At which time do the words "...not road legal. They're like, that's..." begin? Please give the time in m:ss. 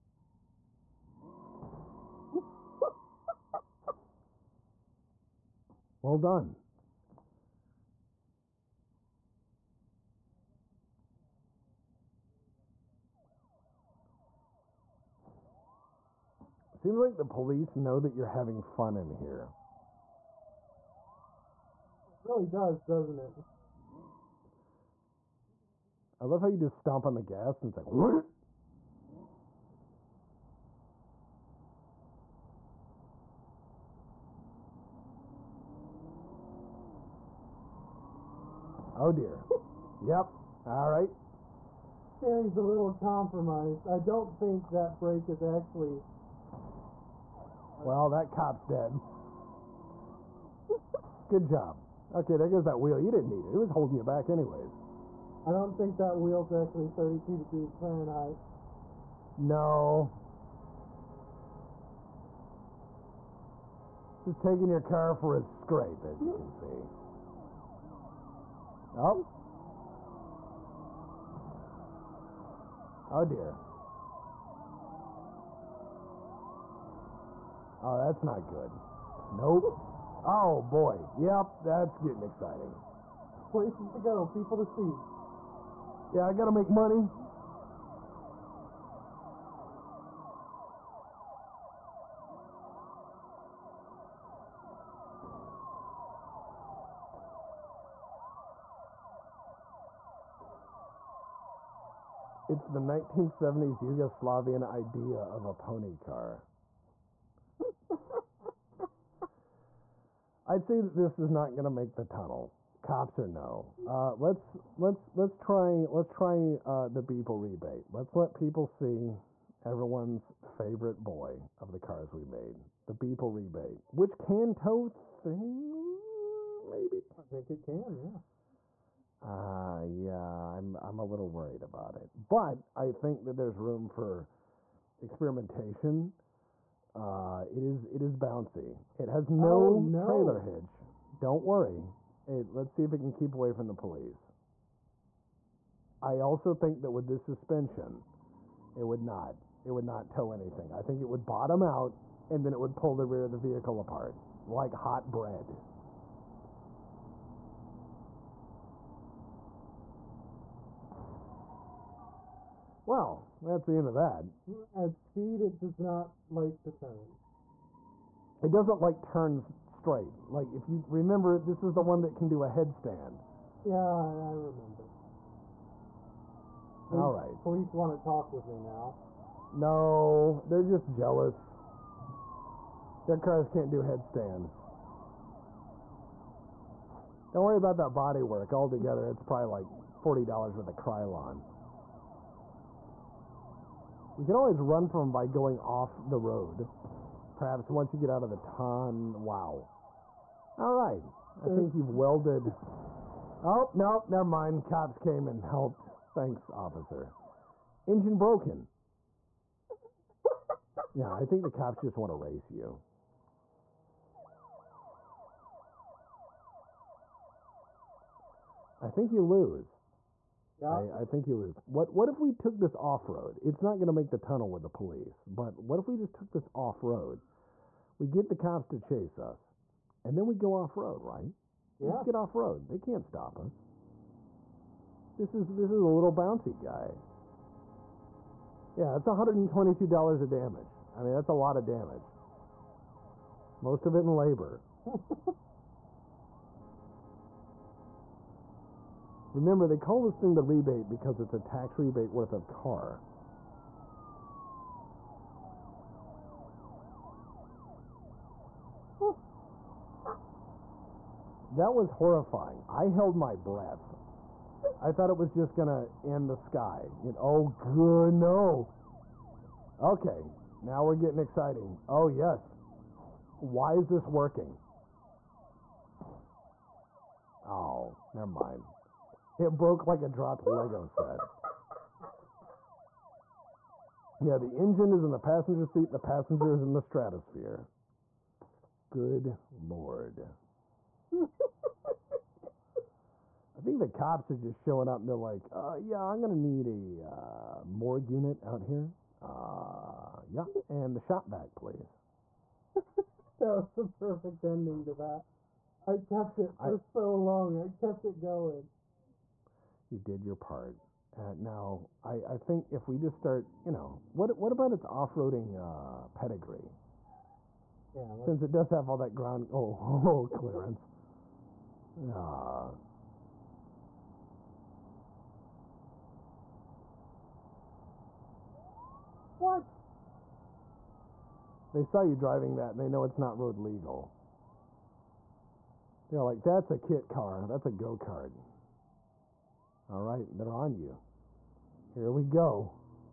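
5:33.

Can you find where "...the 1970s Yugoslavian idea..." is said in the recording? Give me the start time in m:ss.
1:42.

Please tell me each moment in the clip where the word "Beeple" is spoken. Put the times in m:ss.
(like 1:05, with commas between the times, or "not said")
1:57, 2:02.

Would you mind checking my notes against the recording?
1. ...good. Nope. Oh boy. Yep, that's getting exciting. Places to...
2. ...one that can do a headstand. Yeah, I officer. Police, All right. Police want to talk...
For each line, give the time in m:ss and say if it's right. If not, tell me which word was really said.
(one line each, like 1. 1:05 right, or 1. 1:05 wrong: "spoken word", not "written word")
1. 1:18 right
2. 2:51 wrong: "remember", not "officer".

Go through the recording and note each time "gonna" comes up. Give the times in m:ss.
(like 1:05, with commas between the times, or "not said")
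3:43, 4:25.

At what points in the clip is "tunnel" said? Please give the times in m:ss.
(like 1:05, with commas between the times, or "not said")
1:52, 3:44.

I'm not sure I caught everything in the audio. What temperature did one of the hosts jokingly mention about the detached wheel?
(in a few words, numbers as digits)
32 degrees Fahrenheit.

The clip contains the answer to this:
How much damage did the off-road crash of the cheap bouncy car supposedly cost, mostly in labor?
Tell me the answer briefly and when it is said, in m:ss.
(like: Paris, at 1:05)
$122, at 3:59.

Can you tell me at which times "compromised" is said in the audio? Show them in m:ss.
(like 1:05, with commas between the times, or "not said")
0:42.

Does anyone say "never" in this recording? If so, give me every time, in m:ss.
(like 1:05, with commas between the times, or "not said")
3:24, 4:38.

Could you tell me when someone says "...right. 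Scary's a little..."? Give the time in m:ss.
0:40.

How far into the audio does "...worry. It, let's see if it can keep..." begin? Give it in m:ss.
2:21.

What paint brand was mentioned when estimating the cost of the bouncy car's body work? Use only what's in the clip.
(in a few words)
Krylon.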